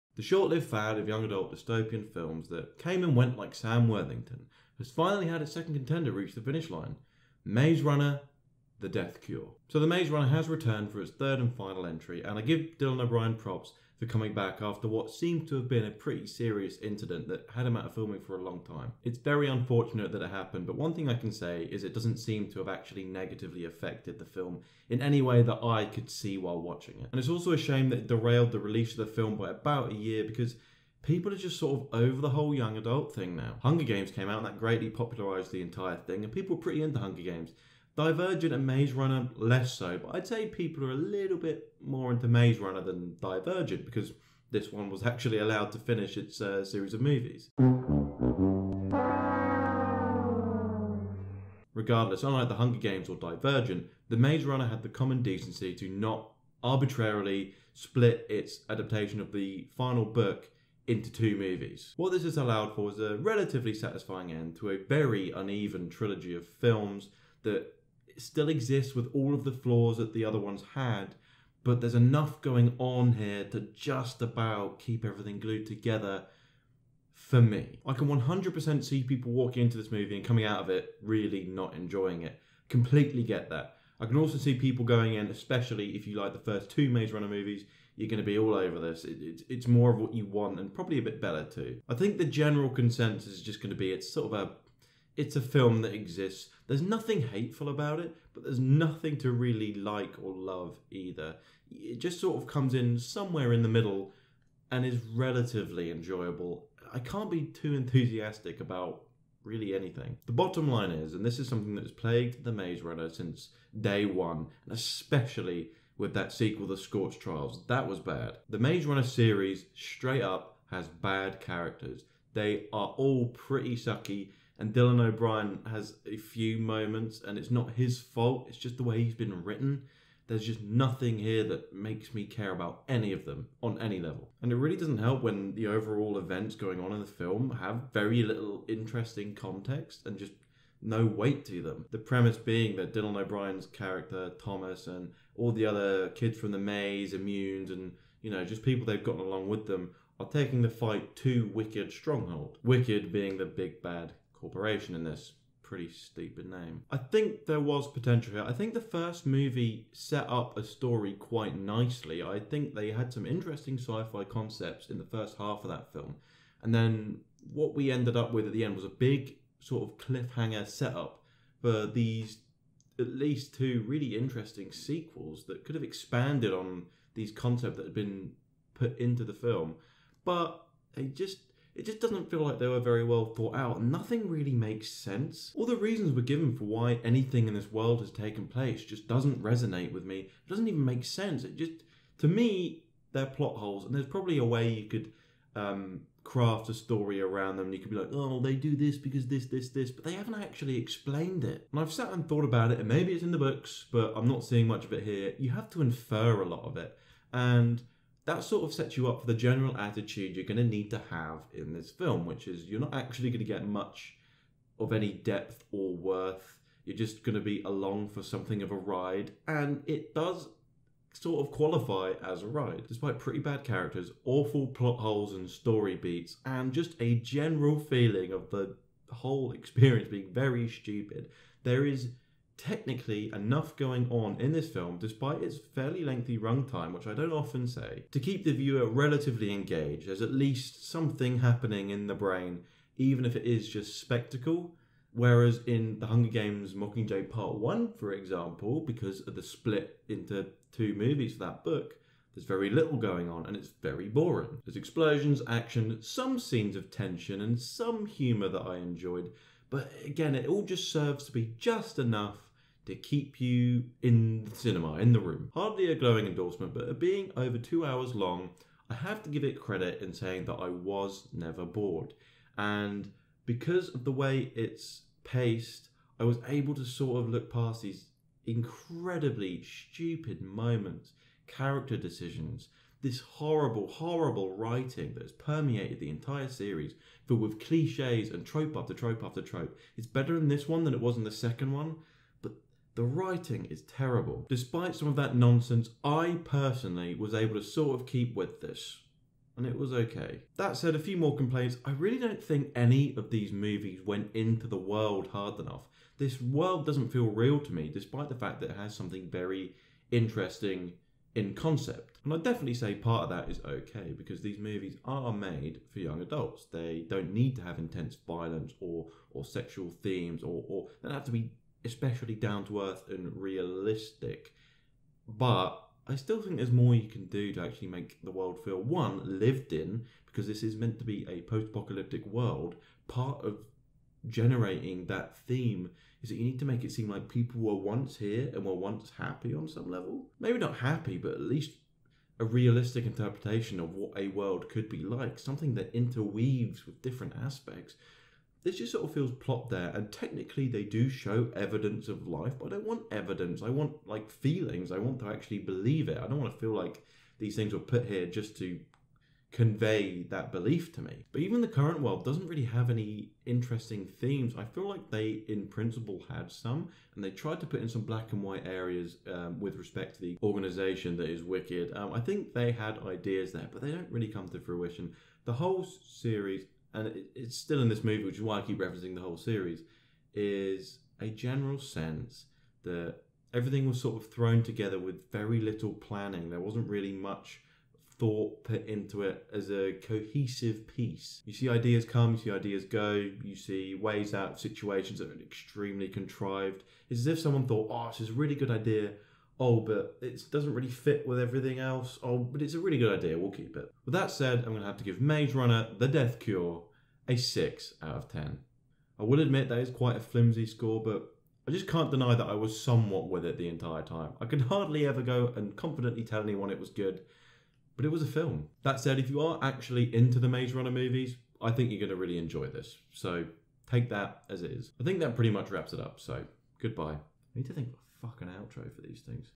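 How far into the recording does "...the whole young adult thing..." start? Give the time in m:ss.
0:32.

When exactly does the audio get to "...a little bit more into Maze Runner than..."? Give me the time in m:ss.
0:40.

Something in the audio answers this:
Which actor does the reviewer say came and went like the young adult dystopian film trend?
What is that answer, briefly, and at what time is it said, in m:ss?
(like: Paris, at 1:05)
Sam Worthington, at 0:03.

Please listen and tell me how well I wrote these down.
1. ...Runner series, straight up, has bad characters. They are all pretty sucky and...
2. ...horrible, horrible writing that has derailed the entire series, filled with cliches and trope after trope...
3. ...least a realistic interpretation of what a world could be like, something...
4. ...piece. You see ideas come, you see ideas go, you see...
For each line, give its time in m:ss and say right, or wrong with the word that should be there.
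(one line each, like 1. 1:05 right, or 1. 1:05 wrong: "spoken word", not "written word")
1. 1:58 right
2. 4:43 wrong: "permeated", not "derailed"
3. 5:41 right
4. 6:30 right.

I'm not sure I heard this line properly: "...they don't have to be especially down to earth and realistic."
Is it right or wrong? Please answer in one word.
right.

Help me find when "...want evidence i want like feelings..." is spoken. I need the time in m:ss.
5:52.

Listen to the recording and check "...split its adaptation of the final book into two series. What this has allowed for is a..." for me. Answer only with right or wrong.
wrong.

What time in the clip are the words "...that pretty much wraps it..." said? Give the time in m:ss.
7:05.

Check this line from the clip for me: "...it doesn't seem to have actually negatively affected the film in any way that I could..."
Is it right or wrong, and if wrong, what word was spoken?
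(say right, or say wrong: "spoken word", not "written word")
right.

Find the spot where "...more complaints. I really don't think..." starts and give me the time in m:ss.
5:01.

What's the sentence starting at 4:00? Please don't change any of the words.
There's at least something happening in the brain, even if it is just spectacle.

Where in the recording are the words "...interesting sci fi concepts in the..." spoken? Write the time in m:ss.
2:43.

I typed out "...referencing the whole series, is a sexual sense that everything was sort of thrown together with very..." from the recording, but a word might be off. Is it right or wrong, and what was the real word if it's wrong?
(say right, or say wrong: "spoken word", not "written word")
wrong: "general", not "sexual".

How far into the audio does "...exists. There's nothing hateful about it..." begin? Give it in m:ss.
1:35.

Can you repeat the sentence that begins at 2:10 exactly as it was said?
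There's just nothing here that makes me care about any of them on any level.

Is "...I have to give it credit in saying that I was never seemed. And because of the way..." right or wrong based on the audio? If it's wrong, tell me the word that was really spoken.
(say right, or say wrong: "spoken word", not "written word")
wrong: "bored", not "seemed".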